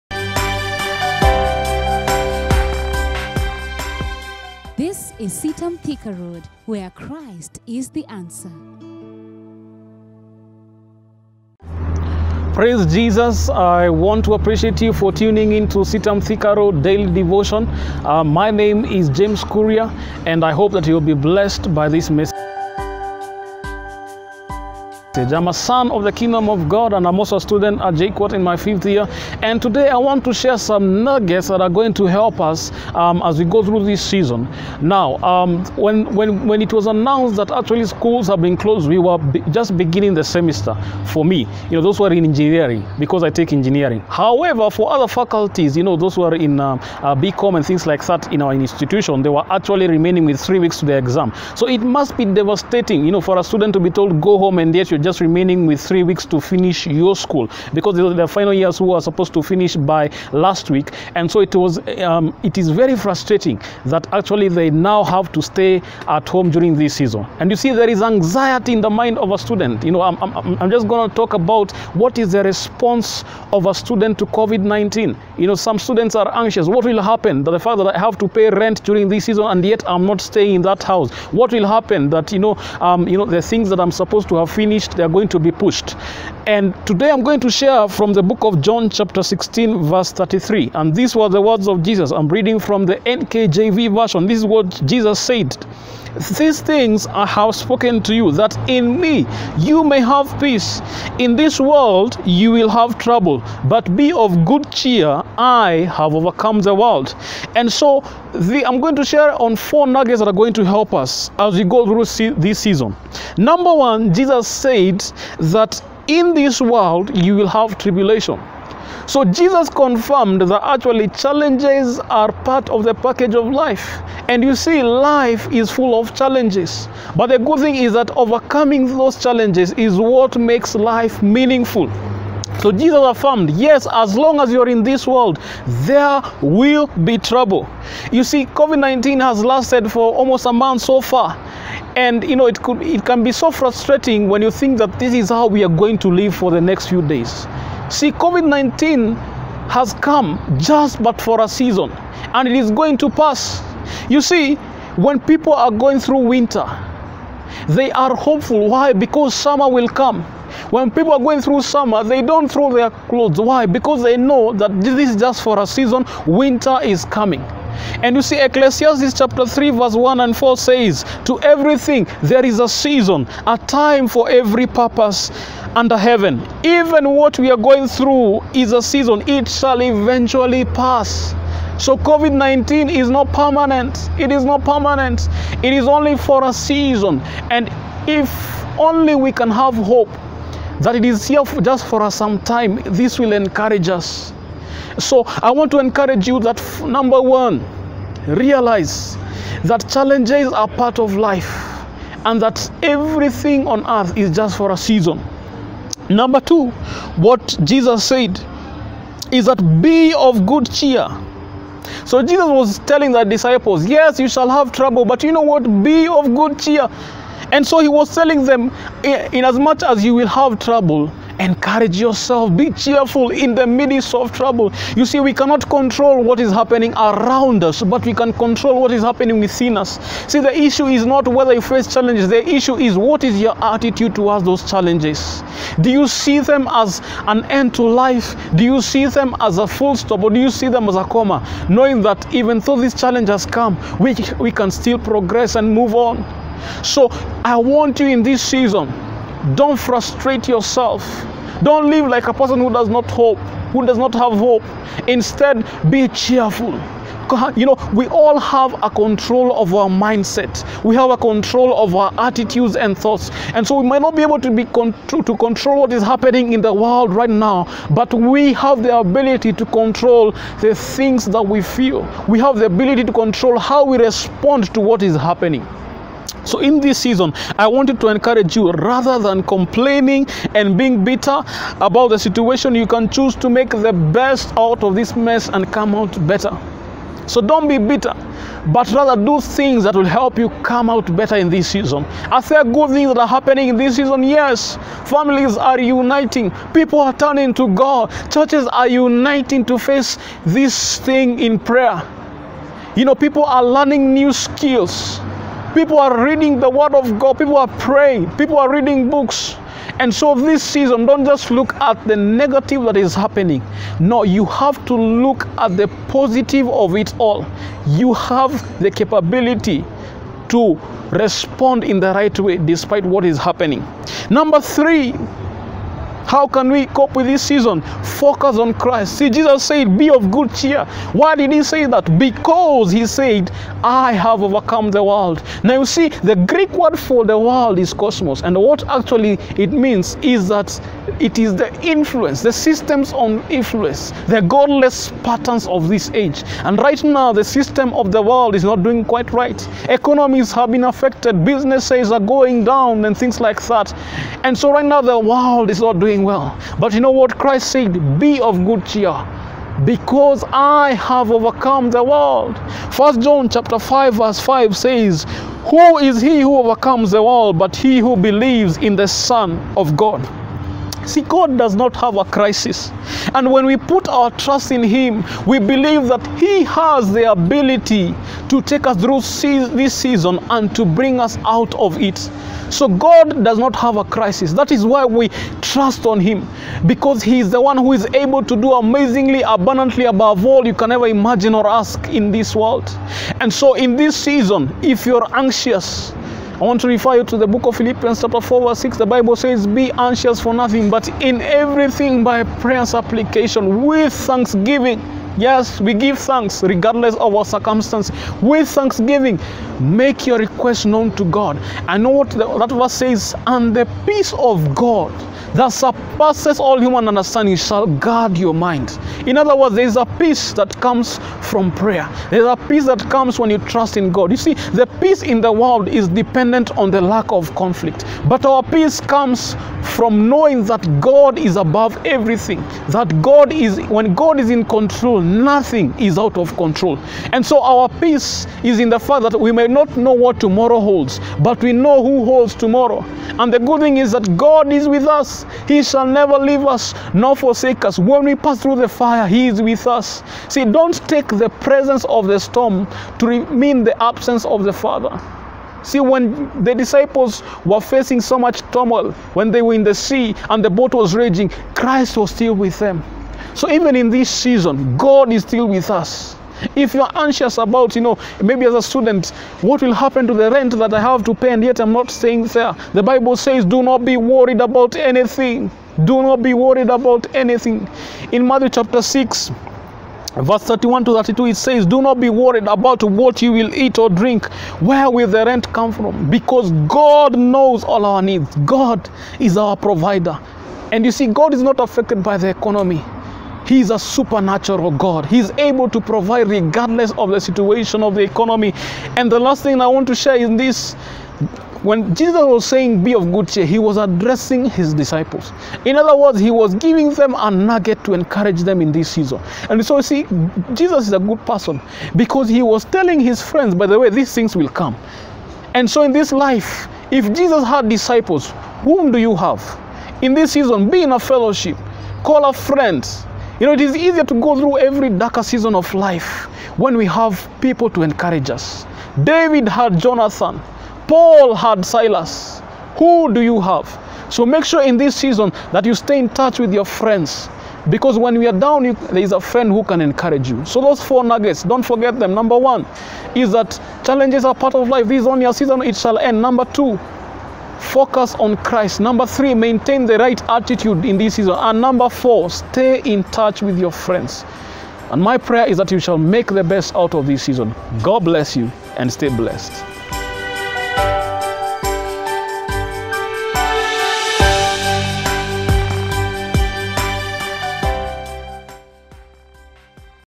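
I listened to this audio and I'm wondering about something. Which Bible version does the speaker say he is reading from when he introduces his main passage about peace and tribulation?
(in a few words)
NKJV.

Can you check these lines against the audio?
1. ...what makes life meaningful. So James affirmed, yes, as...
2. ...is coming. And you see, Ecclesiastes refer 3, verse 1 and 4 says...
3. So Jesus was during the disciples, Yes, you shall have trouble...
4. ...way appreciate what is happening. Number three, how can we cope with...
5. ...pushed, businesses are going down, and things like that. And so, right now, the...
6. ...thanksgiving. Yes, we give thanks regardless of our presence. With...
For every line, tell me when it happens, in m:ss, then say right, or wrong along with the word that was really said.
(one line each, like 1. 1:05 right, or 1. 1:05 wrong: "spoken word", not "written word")
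1. 2:09 wrong: "Jesus", not "James"
2. 2:46 wrong: "chapter", not "refer"
3. 3:32 wrong: "telling", not "during"
4. 5:22 wrong: "despite", not "appreciate"
5. 5:50 wrong: "affected", not "pushed"
6. 6:44 wrong: "circumstance", not "presence".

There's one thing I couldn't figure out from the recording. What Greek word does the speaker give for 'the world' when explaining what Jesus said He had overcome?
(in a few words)
cosmos.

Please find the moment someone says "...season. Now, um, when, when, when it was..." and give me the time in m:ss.
0:34.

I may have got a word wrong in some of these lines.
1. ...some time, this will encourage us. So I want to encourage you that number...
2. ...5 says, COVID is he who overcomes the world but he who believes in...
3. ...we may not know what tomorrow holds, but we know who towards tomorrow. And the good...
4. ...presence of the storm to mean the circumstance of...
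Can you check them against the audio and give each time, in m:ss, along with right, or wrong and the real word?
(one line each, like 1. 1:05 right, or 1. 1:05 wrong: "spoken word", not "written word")
1. 3:12 right
2. 6:04 wrong: "Who", not "COVID"
3. 7:19 wrong: "holds", not "towards"
4. 7:31 wrong: "absence", not "circumstance".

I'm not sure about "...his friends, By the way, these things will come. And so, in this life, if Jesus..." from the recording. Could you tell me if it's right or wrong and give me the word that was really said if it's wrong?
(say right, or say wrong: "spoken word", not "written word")
right.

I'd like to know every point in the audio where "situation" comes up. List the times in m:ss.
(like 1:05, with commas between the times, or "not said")
4:42, 8:17.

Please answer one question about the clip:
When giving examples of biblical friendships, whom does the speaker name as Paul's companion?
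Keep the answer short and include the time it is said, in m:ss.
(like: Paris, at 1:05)
Silas, at 8:51.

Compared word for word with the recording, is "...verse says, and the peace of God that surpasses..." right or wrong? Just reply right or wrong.
right.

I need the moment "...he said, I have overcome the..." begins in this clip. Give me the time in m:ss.
5:32.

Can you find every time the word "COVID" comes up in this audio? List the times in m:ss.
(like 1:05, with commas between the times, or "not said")
1:14, 2:18, 2:28, 3:01.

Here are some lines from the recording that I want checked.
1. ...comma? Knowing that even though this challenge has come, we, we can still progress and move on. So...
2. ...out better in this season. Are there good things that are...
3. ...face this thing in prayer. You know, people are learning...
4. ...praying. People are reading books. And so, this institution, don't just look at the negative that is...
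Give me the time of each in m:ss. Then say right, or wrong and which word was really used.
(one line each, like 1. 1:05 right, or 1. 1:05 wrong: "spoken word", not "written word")
1. 4:01 right
2. 4:50 right
3. 4:59 right
4. 5:07 wrong: "season", not "institution".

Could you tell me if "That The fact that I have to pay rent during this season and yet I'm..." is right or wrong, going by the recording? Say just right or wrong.
right.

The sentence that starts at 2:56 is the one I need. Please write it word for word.
Even what we are going through is a season, it shall eventually pass.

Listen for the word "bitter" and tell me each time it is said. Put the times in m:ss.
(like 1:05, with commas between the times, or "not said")
4:41, 4:47.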